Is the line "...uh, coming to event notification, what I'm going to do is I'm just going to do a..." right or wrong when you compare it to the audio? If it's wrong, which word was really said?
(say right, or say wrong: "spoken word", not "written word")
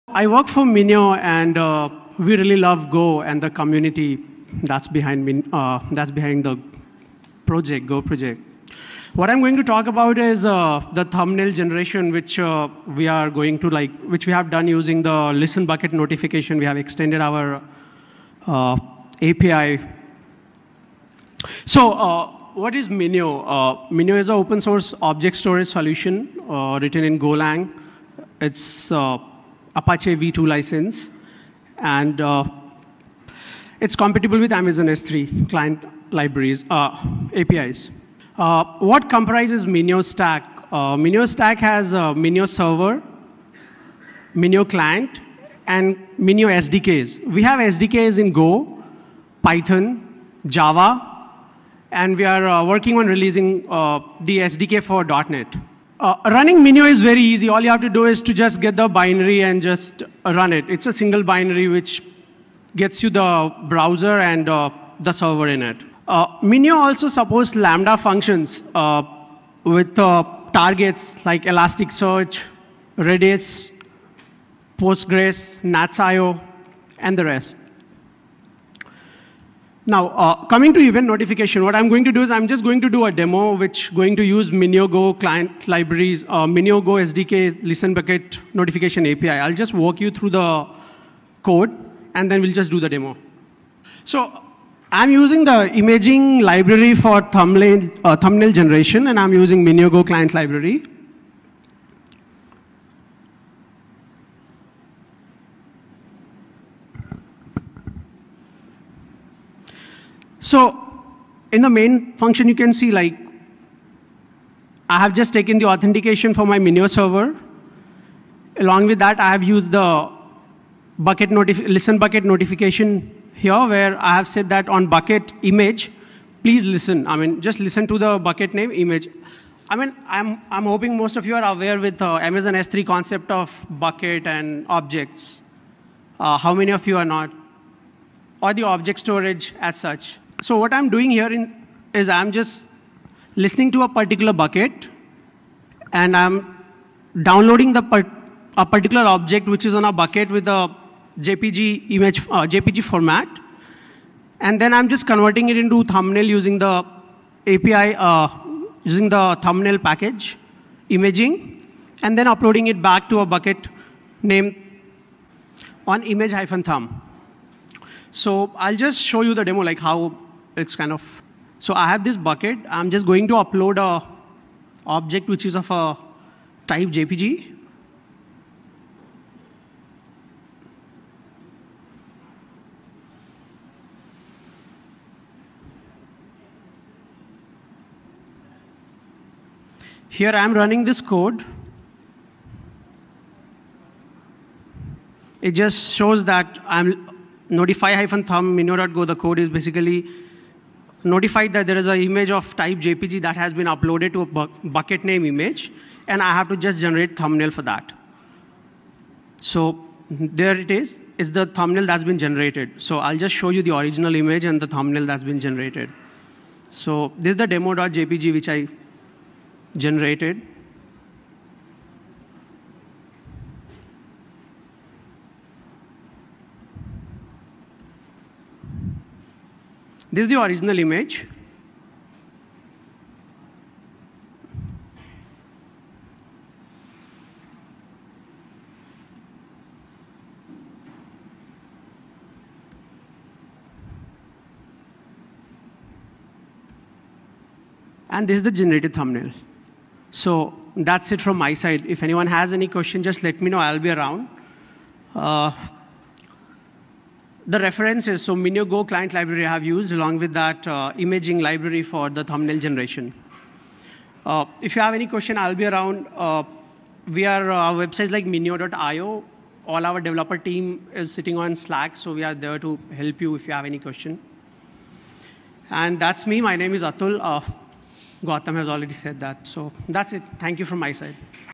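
right.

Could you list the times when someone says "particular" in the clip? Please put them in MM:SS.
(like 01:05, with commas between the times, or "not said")
02:23, 02:28.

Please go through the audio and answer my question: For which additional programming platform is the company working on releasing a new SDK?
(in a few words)
NET.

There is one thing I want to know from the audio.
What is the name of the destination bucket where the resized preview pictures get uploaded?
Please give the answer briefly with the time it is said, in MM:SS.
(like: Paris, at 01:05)
image-thumb, at 02:46.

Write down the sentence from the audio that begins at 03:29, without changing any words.
So there it is, is the thumbnail that's been generated.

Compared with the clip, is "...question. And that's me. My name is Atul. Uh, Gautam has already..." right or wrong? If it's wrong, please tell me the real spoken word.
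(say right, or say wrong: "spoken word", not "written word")
right.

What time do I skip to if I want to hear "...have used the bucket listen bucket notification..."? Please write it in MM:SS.
01:59.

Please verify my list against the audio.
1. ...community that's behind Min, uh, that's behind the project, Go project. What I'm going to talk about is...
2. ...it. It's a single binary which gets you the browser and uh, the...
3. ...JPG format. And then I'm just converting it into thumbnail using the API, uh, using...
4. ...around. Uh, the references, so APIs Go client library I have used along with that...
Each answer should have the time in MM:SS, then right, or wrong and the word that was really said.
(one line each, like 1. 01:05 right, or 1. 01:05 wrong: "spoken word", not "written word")
1. 00:03 right
2. 01:00 right
3. 02:32 right
4. 04:13 wrong: "Minio", not "APIs".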